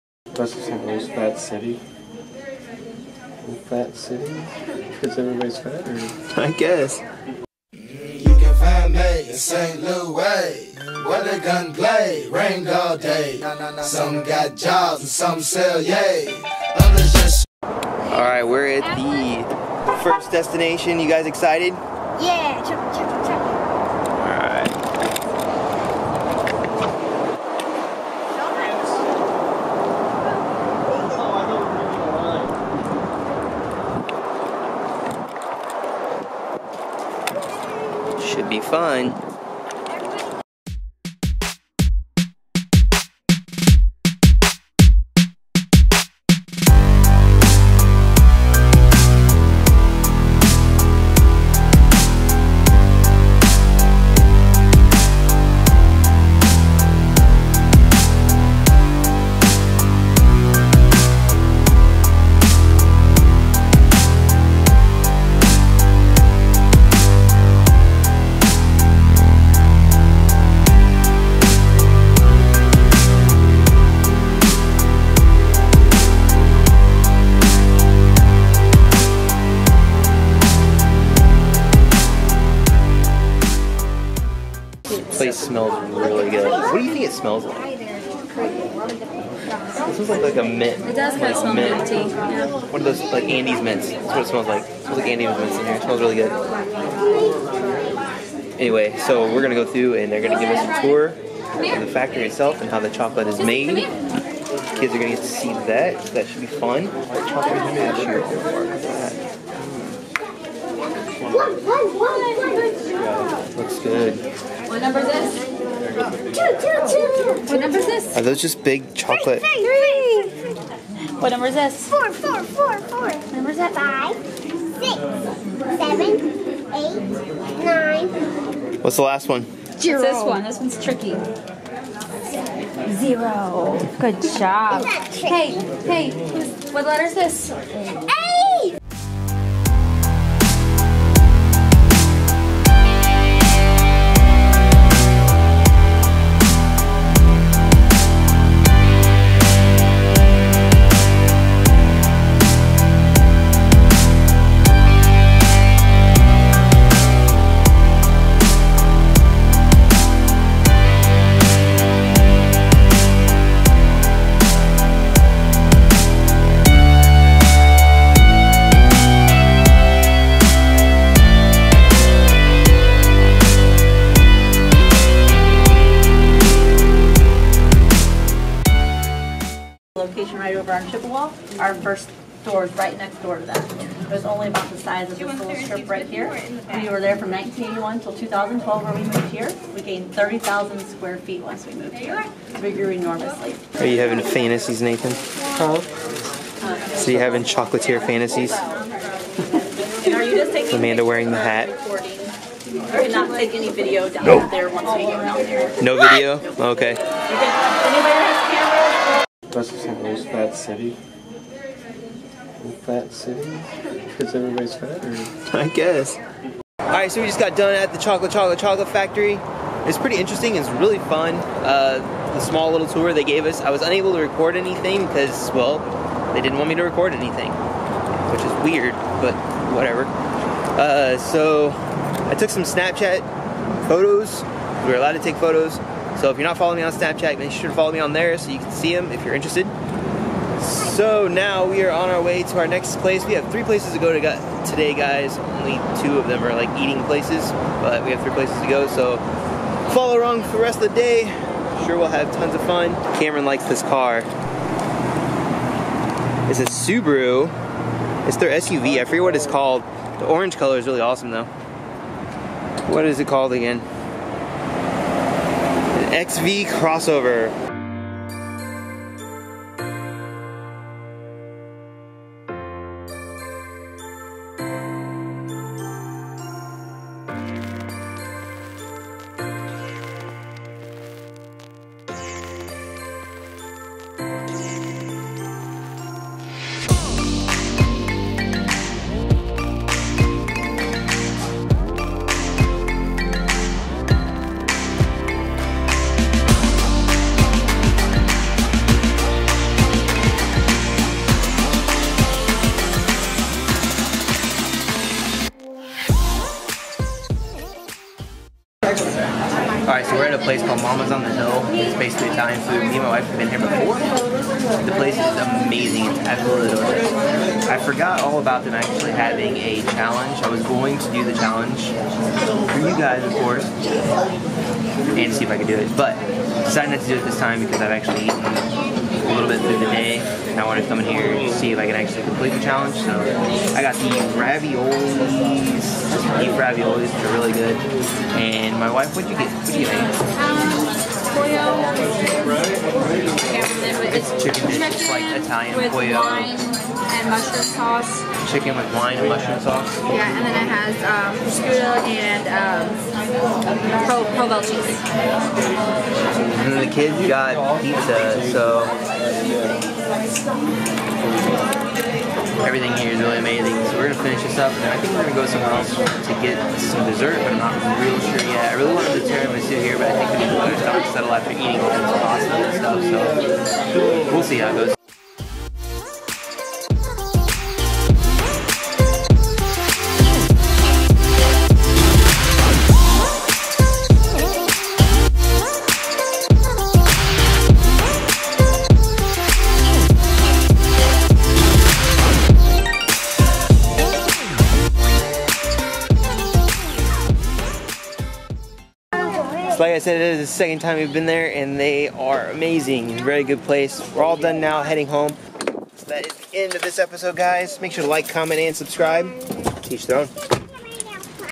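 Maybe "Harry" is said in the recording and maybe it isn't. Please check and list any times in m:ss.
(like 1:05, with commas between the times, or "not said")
not said.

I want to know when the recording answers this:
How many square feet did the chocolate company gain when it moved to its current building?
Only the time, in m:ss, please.
3:10.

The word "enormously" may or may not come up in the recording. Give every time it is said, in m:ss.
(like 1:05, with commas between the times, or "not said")
3:12.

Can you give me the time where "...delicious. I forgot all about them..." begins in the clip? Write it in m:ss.
5:16.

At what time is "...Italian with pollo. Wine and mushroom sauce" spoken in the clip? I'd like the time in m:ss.
5:45.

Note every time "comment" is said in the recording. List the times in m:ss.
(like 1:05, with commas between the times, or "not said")
6:48.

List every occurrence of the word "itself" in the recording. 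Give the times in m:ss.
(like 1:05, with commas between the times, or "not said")
1:42.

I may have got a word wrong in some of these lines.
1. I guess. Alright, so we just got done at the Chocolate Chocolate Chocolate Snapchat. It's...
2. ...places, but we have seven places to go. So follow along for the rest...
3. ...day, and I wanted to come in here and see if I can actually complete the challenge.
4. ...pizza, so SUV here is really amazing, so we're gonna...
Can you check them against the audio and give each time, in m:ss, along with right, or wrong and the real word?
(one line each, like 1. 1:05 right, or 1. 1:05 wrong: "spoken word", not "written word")
1. 3:35 wrong: "Factory", not "Snapchat"
2. 4:07 wrong: "three", not "seven"
3. 5:29 right
4. 5:57 wrong: "Everything", not "SUV".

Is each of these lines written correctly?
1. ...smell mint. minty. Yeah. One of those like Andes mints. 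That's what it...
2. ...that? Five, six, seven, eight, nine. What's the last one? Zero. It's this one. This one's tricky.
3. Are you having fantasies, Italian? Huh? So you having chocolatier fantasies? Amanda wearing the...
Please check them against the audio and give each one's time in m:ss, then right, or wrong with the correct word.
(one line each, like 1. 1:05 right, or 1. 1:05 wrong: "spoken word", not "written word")
1. 1:31 right
2. 2:03 right
3. 3:13 wrong: "Nathan", not "Italian".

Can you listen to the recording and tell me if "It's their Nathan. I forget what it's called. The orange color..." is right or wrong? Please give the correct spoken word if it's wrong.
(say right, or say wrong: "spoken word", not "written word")
wrong: "SUV", not "Nathan".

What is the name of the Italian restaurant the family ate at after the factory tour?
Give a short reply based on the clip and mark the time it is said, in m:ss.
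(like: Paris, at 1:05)
Mama's on the Hill, at 5:10.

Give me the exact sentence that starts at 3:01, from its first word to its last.
Our first store is right next door to that.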